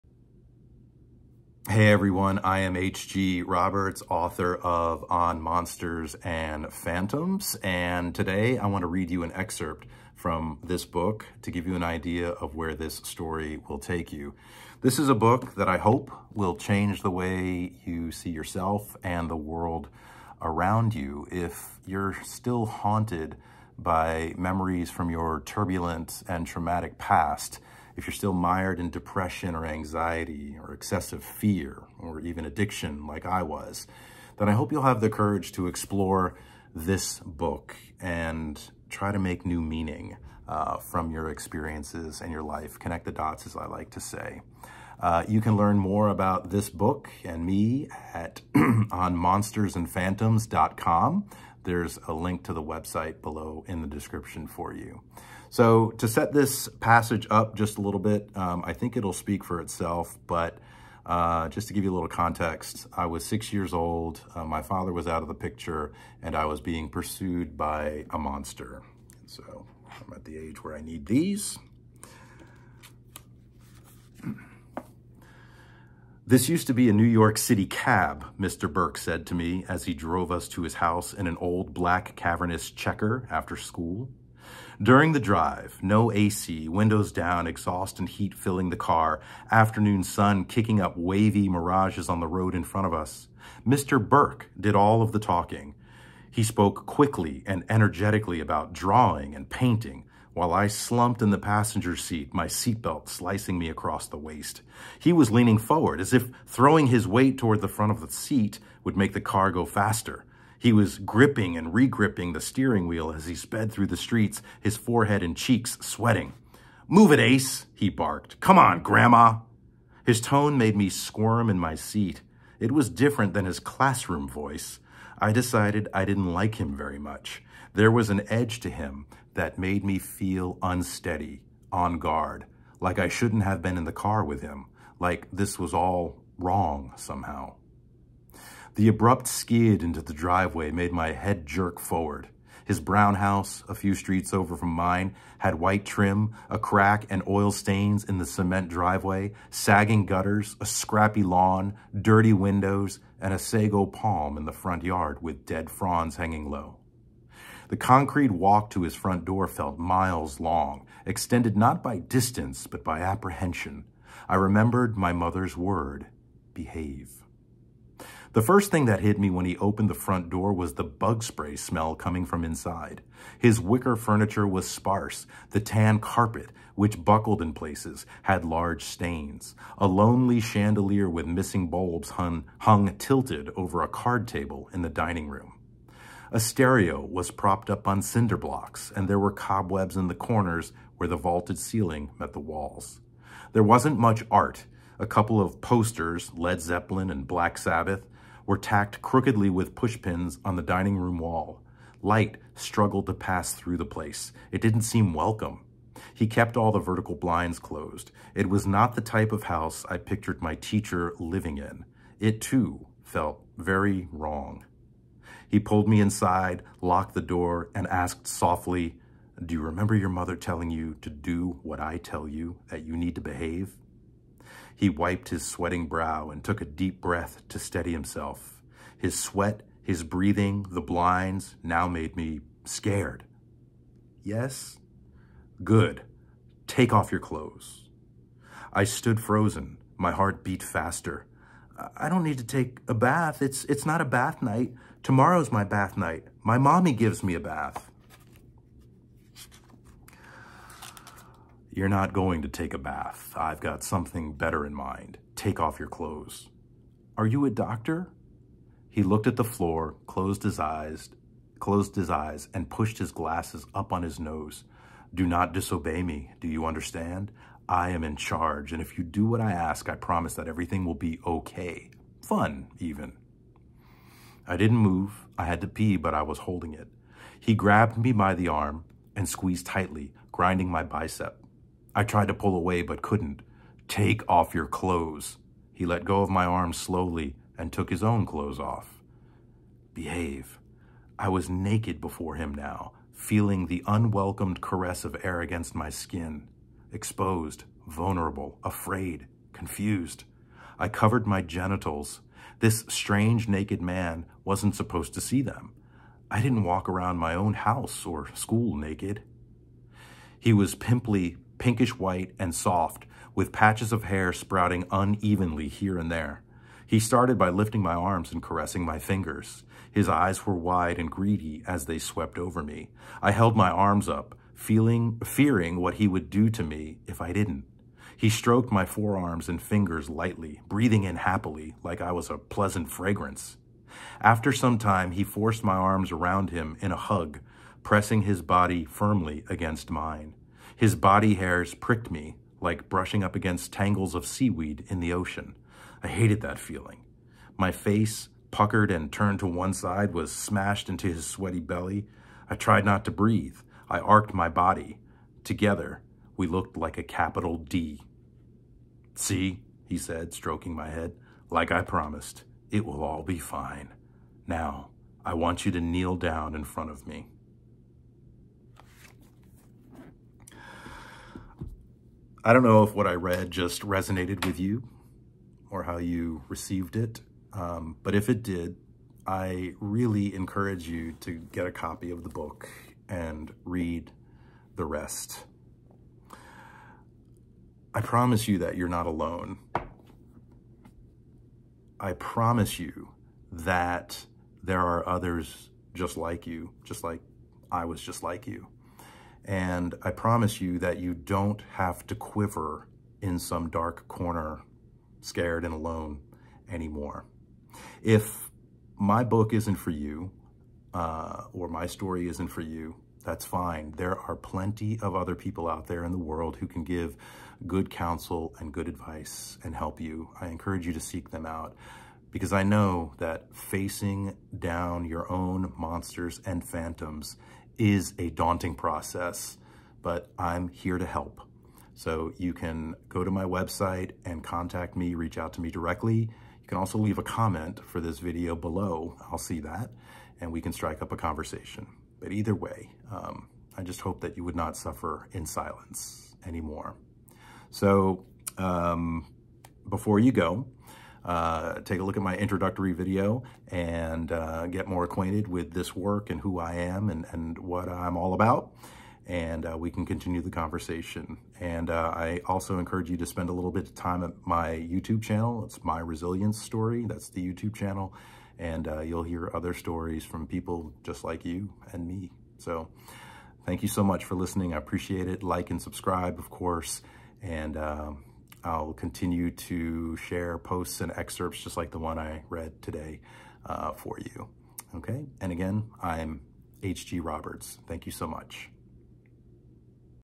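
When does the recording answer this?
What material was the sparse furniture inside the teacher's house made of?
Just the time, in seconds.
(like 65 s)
173 s.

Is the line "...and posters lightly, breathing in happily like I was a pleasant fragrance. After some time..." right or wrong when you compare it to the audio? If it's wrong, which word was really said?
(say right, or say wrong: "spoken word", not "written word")
wrong: "fingers", not "posters".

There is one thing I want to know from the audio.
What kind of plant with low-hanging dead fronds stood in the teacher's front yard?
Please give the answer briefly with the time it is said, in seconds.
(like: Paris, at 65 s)
Sago palm, at 153 s.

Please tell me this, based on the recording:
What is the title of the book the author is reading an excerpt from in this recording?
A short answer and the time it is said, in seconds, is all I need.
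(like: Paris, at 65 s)
On Monsters and Phantoms, at 5 s.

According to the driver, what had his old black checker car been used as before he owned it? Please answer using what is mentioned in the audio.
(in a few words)
New York City cab.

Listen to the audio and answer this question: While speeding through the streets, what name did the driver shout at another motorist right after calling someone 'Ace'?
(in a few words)
Grandma.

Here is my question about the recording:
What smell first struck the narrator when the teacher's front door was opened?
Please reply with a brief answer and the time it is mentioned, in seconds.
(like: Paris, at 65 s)
Bug spray, at 170 s.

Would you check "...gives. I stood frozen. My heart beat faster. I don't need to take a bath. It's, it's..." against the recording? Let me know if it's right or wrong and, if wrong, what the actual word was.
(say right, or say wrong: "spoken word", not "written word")
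wrong: "clothes", not "gives".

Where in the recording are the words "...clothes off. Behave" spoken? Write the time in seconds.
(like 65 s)
288 s.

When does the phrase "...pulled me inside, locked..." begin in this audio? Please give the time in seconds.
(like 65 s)
215 s.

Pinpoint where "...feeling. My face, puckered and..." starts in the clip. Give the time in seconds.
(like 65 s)
346 s.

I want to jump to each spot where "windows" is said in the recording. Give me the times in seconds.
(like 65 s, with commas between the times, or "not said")
86 s, 152 s.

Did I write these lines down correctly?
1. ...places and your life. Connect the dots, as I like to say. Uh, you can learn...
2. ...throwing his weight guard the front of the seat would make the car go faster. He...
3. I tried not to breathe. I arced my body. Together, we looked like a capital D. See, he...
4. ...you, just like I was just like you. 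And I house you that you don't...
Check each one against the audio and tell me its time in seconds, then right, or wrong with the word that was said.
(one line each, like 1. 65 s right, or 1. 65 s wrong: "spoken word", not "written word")
1. 41 s wrong: "experiences", not "places"
2. 106 s wrong: "toward", not "guard"
3. 352 s right
4. 396 s wrong: "promise", not "house".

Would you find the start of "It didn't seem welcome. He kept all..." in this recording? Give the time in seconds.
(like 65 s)
204 s.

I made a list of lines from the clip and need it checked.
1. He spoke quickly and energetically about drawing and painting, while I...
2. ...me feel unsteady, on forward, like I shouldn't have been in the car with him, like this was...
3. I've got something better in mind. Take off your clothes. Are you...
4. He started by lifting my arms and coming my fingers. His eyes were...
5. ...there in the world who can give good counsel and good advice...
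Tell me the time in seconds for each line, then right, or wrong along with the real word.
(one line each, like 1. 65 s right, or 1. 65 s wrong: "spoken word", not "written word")
1. 96 s right
2. 129 s wrong: "guard", not "forward"
3. 253 s right
4. 316 s wrong: "caressing", not "coming"
5. 415 s right.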